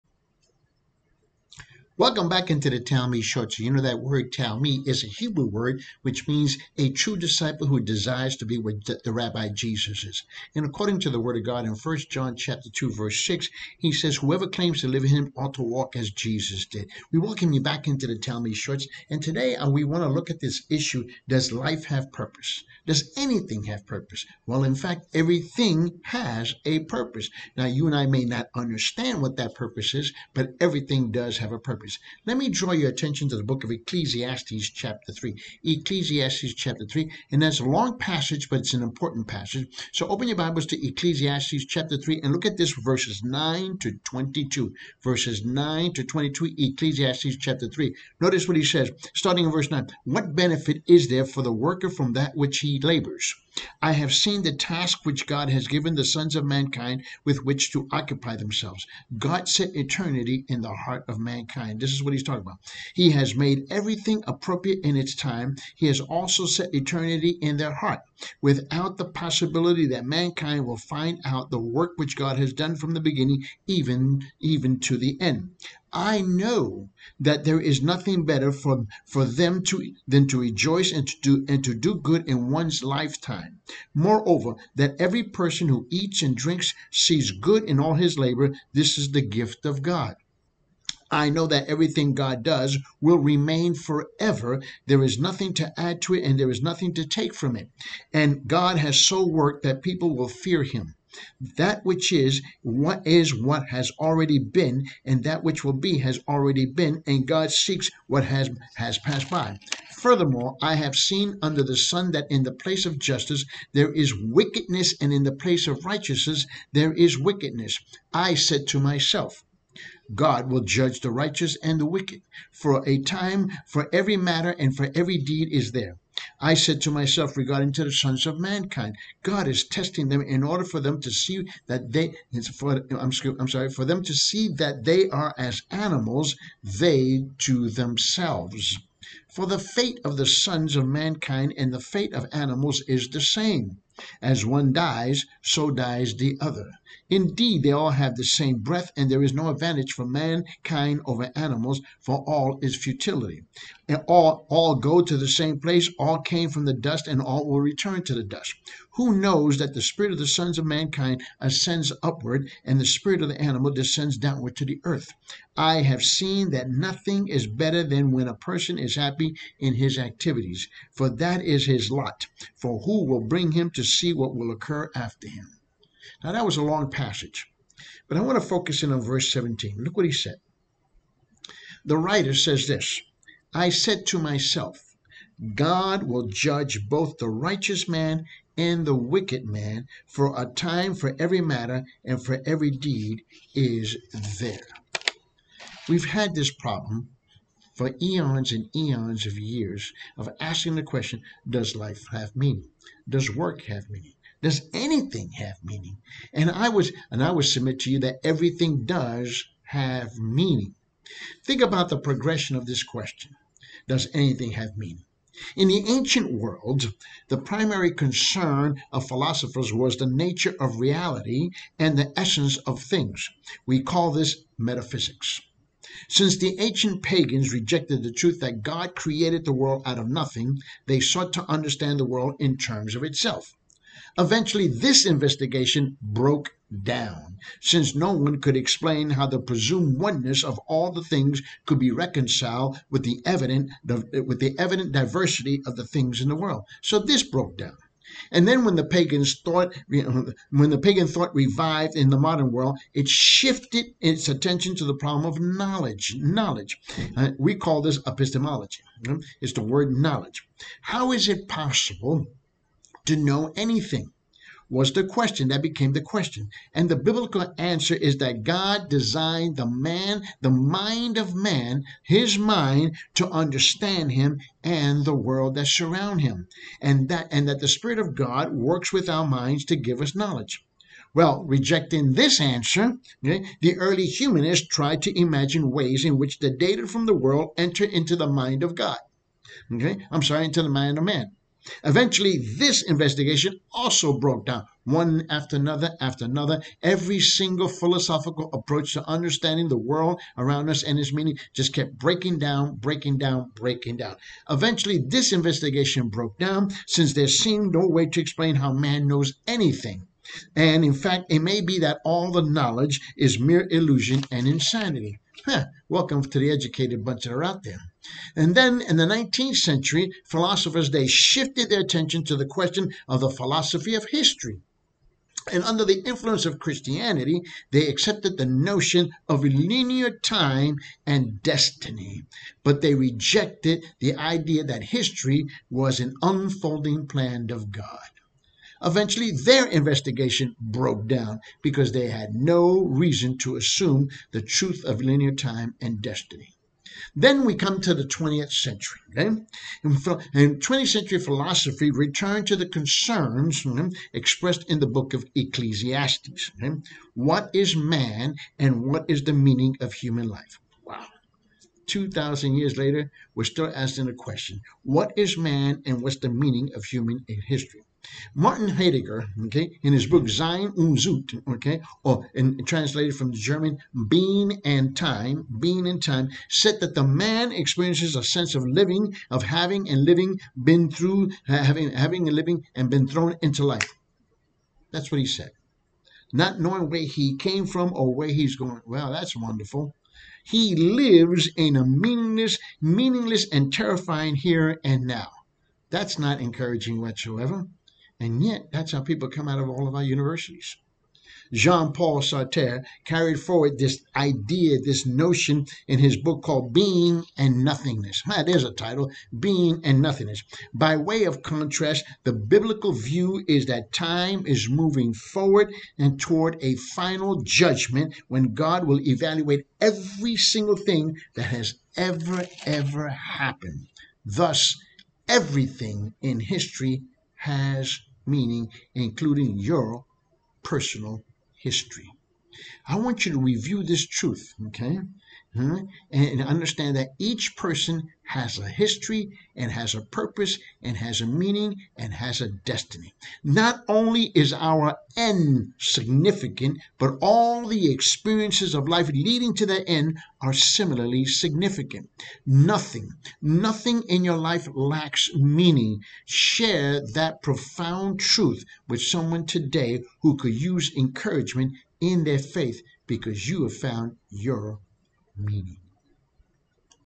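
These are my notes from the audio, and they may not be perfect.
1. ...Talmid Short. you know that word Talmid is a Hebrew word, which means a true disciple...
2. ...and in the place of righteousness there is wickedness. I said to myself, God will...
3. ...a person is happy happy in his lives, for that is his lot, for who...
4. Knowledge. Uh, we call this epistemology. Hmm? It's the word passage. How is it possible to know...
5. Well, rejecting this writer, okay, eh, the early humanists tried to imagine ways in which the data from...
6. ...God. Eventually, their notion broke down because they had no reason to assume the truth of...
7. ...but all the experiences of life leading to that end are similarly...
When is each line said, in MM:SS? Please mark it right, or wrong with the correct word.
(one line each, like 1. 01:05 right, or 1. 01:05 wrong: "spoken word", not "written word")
1. 00:02 right
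2. 01:55 right
3. 02:48 wrong: "activities", not "lives"
4. 04:16 wrong: "knowledge", not "passage"
5. 04:41 wrong: "answer", not "writer"
6. 05:37 wrong: "investigation", not "notion"
7. 07:26 right.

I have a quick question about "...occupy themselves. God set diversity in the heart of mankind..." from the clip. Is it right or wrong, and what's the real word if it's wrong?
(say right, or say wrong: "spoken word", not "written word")
wrong: "eternity", not "diversity".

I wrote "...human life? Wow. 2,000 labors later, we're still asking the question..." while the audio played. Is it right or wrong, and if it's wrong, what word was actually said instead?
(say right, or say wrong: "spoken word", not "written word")
wrong: "years", not "labors".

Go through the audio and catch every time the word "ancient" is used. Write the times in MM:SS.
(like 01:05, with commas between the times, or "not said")
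03:35, 03:46.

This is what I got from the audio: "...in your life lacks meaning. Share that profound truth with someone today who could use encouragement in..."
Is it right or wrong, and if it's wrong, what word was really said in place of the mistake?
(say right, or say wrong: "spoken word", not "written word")
right.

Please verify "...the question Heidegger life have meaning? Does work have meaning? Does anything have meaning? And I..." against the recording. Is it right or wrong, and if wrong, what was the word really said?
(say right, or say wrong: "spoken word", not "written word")
wrong: "Does", not "Heidegger".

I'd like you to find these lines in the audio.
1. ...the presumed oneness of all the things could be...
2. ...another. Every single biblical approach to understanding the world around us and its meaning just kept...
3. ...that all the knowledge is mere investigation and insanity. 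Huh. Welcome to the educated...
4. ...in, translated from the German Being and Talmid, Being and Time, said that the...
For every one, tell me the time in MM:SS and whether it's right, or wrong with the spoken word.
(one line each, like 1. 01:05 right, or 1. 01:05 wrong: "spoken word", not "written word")
1. 03:59 right
2. 04:56 wrong: "philosophical", not "biblical"
3. 05:11 wrong: "illusion", not "investigation"
4. 06:12 wrong: "Time", not "Talmid".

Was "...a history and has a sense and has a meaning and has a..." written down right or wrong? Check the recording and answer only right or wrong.
wrong.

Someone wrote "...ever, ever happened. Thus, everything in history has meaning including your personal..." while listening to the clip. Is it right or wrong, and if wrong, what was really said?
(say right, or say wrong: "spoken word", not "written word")
right.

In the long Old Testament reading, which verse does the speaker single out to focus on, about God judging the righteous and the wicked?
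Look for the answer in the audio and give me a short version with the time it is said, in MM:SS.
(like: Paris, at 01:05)
Verse 17, at 02:59.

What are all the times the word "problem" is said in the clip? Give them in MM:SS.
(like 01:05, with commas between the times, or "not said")
03:16, 04:14.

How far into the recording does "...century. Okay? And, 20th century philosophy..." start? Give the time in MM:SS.
05:48.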